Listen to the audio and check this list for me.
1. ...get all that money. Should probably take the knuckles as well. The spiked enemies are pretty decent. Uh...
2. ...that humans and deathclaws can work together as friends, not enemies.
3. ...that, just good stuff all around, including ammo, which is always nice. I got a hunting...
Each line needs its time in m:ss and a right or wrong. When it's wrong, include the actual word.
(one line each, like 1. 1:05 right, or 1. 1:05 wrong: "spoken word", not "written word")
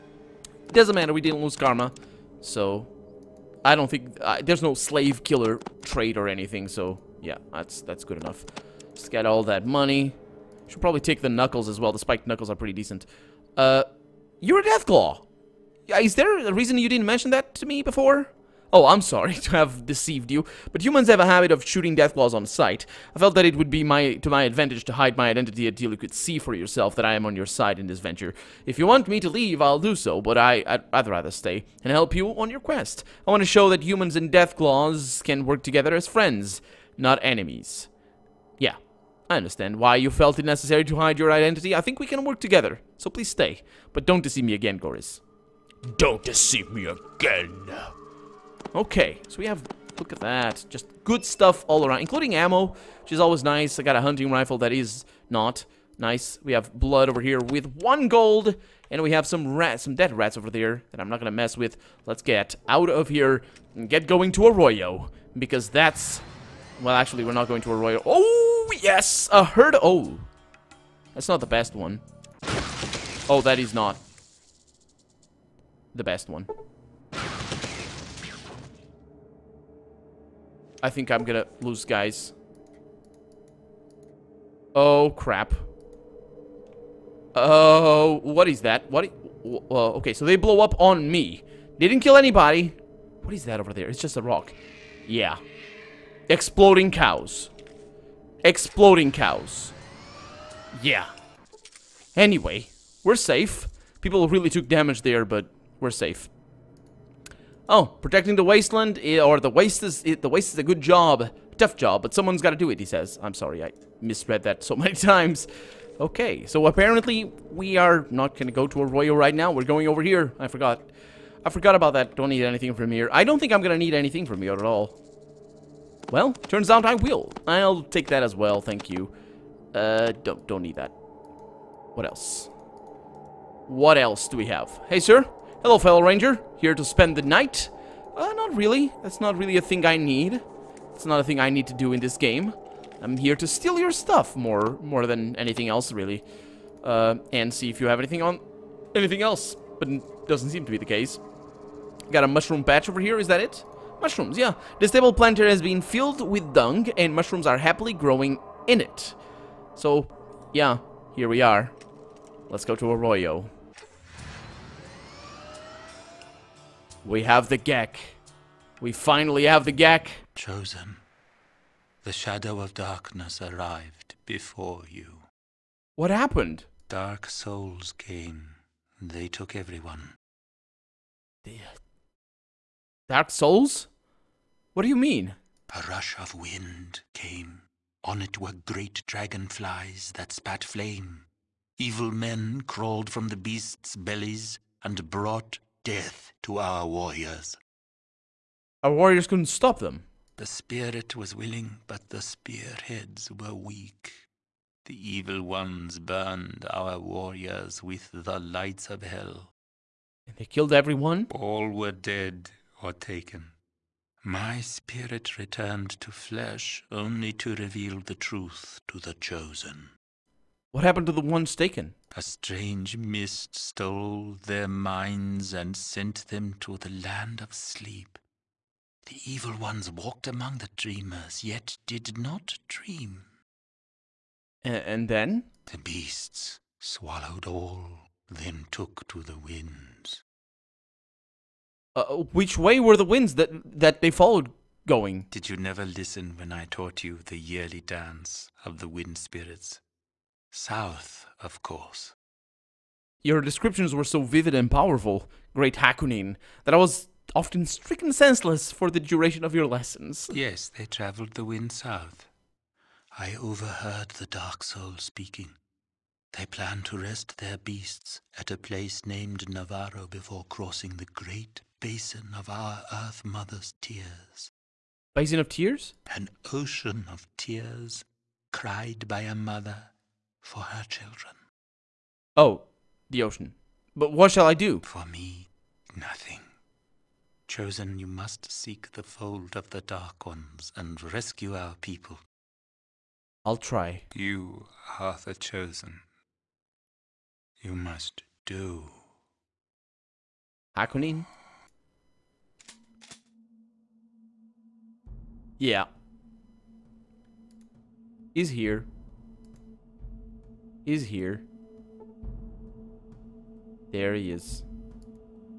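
1. 0:09 wrong: "knuckles", not "enemies"
2. 0:33 right
3. 0:50 right.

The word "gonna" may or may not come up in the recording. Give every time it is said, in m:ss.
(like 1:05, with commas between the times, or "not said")
1:01, 1:21, 1:58, 2:03.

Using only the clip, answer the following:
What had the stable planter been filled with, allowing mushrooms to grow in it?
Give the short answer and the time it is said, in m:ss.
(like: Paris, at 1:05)
Dung, at 2:36.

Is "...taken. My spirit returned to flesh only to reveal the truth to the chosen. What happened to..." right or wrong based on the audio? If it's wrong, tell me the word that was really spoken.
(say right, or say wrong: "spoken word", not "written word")
right.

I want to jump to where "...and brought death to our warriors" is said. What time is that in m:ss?
3:14.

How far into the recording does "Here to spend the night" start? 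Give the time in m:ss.
2:16.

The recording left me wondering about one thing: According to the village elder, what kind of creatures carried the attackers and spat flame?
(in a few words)
Great dragonflies.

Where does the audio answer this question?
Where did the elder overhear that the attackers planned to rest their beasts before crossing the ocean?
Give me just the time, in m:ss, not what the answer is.
4:29.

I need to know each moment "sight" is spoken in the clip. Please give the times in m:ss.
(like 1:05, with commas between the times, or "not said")
0:22.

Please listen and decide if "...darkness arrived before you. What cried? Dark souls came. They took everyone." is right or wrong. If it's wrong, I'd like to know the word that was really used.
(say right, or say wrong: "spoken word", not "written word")
wrong: "happened", not "cried".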